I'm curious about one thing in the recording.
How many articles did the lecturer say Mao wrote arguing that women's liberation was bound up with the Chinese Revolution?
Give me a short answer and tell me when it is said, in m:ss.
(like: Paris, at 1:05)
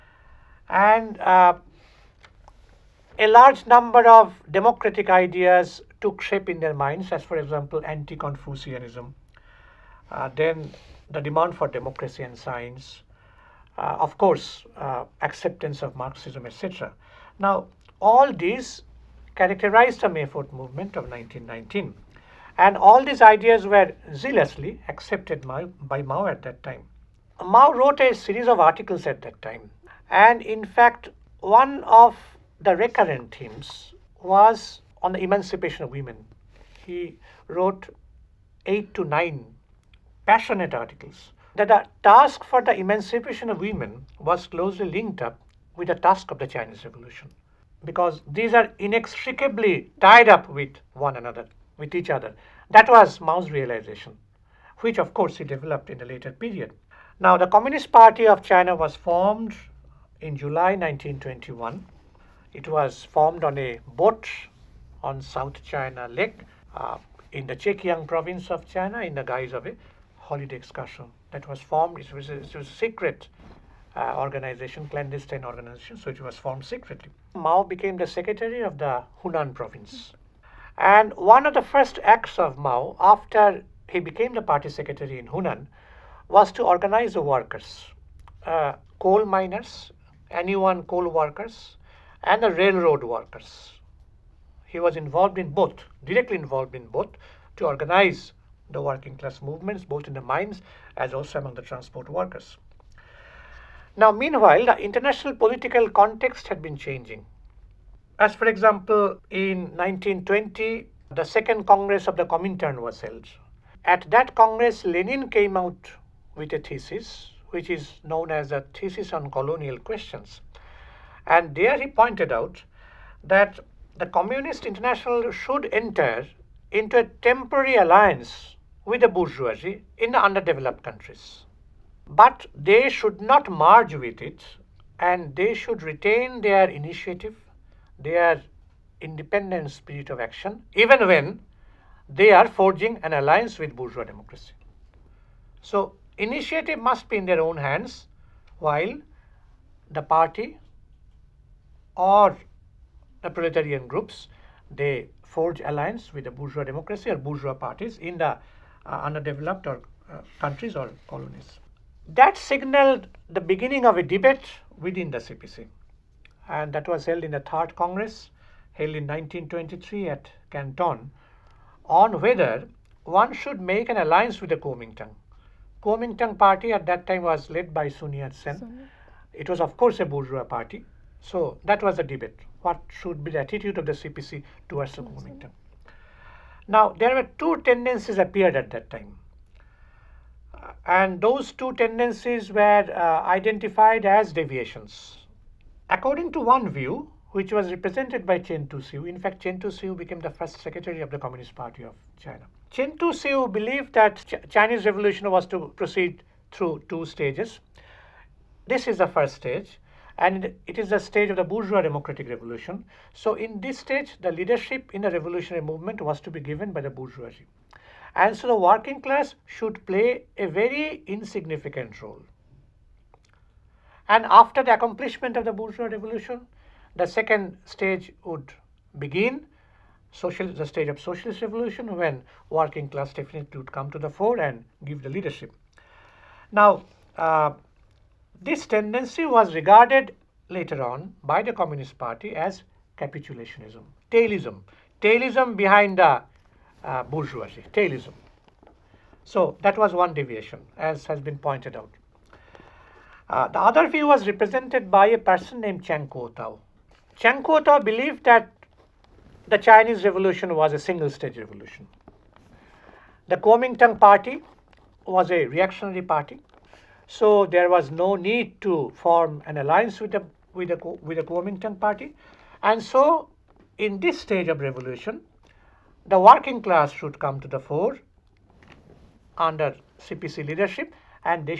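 8 to 9, at 0:38.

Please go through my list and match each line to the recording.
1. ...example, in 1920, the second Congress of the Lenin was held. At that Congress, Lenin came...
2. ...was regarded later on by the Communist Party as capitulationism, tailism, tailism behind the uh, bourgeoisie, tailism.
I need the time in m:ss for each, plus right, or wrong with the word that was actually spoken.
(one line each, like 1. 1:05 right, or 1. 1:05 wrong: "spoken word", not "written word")
1. 1:48 wrong: "Comintern", not "Lenin"
2. 3:59 right.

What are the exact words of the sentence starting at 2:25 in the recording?
So, initiative must be in their own hands while the party or the proletarian groups.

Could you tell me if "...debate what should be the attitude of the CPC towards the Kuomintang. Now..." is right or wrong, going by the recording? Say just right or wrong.
right.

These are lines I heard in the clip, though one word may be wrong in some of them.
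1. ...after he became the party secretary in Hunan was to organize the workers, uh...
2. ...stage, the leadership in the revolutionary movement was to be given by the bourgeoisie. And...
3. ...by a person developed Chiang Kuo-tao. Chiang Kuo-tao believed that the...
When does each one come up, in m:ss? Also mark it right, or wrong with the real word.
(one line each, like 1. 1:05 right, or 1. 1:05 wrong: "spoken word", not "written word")
1. 1:22 right
2. 3:33 right
3. 4:14 wrong: "named", not "developed".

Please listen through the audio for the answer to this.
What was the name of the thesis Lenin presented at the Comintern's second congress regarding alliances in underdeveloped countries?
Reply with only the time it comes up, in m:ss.
1:58.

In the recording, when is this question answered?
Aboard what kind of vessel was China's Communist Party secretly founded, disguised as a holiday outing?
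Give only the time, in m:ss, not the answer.
1:03.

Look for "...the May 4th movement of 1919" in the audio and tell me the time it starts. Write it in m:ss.
0:20.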